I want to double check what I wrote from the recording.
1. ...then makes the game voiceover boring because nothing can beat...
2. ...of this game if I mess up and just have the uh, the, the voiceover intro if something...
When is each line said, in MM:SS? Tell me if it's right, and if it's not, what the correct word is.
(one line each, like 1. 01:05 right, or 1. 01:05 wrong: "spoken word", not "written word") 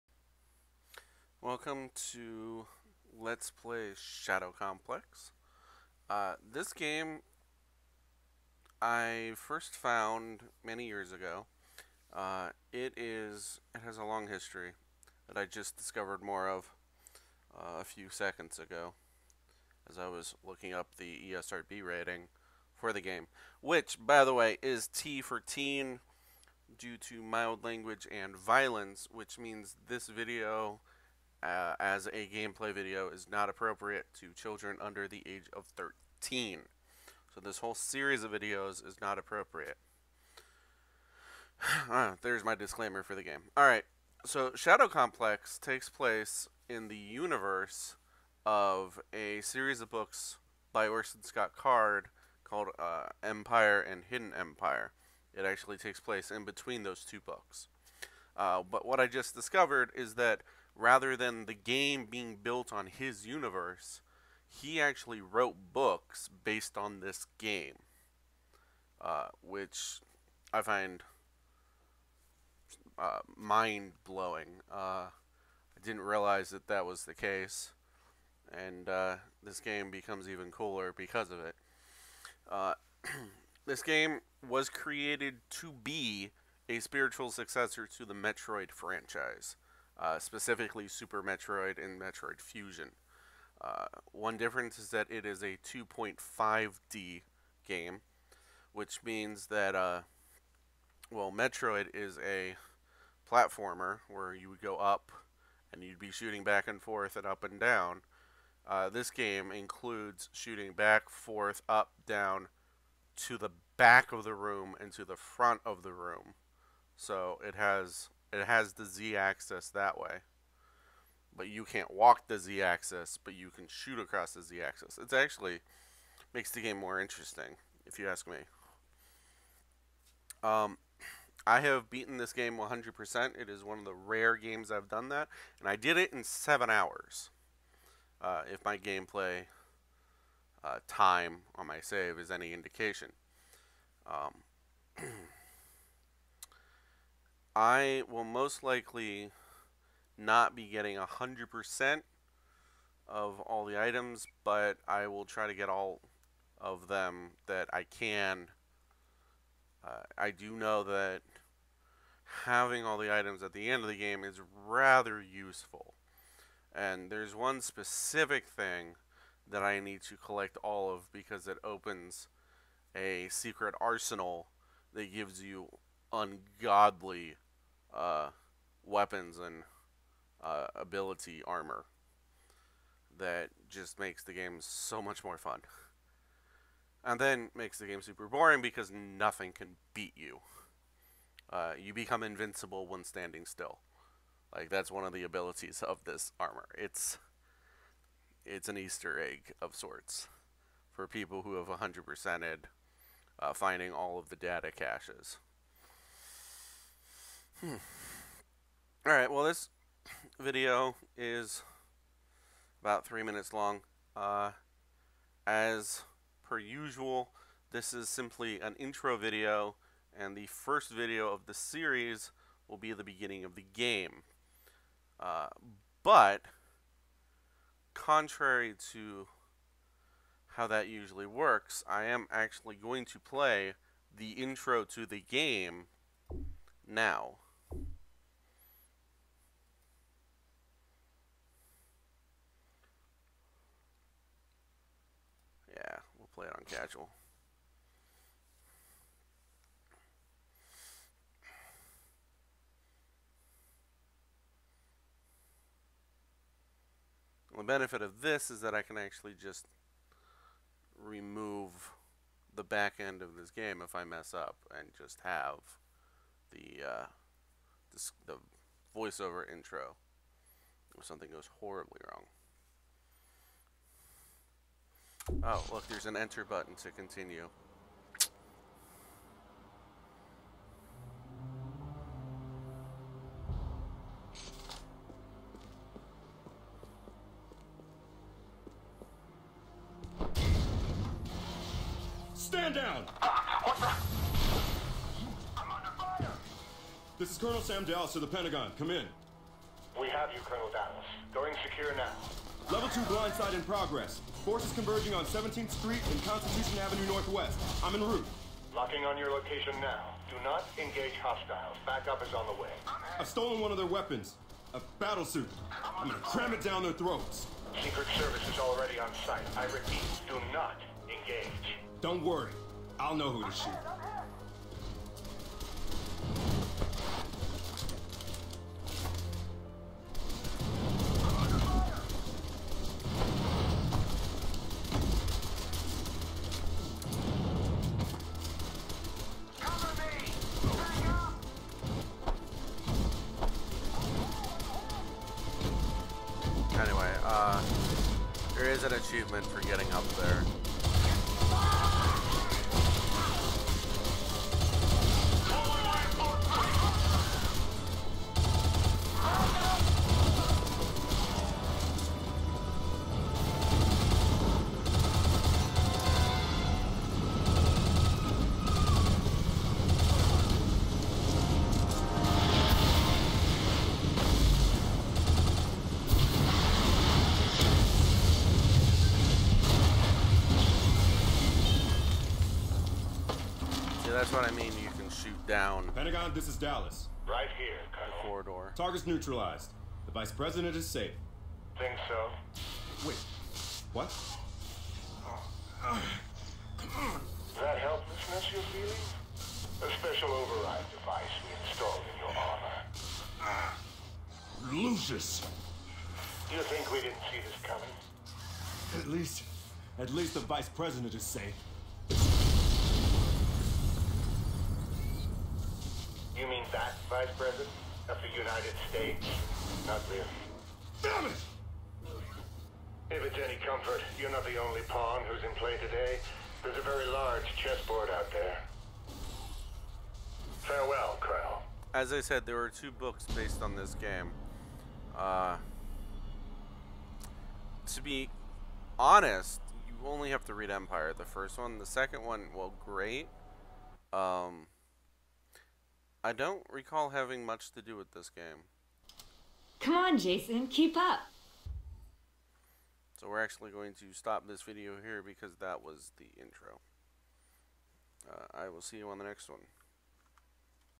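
1. 03:07 wrong: "super", not "voiceover"
2. 04:23 right.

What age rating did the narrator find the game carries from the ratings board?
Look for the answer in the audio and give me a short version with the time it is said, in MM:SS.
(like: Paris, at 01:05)
T for teen, at 00:24.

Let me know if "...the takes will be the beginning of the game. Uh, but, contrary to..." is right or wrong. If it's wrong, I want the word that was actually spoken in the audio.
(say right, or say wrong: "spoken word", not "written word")
wrong: "series", not "takes".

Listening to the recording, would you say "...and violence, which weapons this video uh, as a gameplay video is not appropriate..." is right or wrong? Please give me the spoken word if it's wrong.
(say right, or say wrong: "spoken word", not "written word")
wrong: "means", not "weapons".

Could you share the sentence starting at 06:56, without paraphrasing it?
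that, Vice President, of the United States.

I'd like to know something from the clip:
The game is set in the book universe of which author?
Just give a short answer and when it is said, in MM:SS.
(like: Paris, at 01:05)
Orson Scott Card, at 00:50.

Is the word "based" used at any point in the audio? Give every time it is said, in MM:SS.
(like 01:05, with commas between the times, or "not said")
01:06, 07:13.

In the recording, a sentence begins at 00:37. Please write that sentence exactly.
So this whole series of videos is not appropriate.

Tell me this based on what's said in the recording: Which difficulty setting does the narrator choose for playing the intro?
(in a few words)
casual.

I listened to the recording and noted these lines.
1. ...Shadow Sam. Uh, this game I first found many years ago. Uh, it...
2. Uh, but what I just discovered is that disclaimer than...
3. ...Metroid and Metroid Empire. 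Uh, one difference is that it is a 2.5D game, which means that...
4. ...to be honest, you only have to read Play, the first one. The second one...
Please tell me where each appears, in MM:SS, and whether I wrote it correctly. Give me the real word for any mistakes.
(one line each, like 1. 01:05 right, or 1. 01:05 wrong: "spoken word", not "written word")
1. 00:03 wrong: "Complex", not "Sam"
2. 00:58 wrong: "rather", not "disclaimer"
3. 01:31 wrong: "Fusion", not "Empire"
4. 07:17 wrong: "Empire", not "Play".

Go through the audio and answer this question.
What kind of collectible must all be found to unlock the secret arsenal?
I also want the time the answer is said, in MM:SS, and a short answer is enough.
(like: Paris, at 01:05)
data caches, at 03:24.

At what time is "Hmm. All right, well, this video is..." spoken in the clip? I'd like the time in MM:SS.
03:27.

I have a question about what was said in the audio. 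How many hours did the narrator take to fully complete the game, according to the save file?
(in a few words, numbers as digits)
7.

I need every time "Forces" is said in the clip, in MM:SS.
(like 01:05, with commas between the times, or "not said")
05:04.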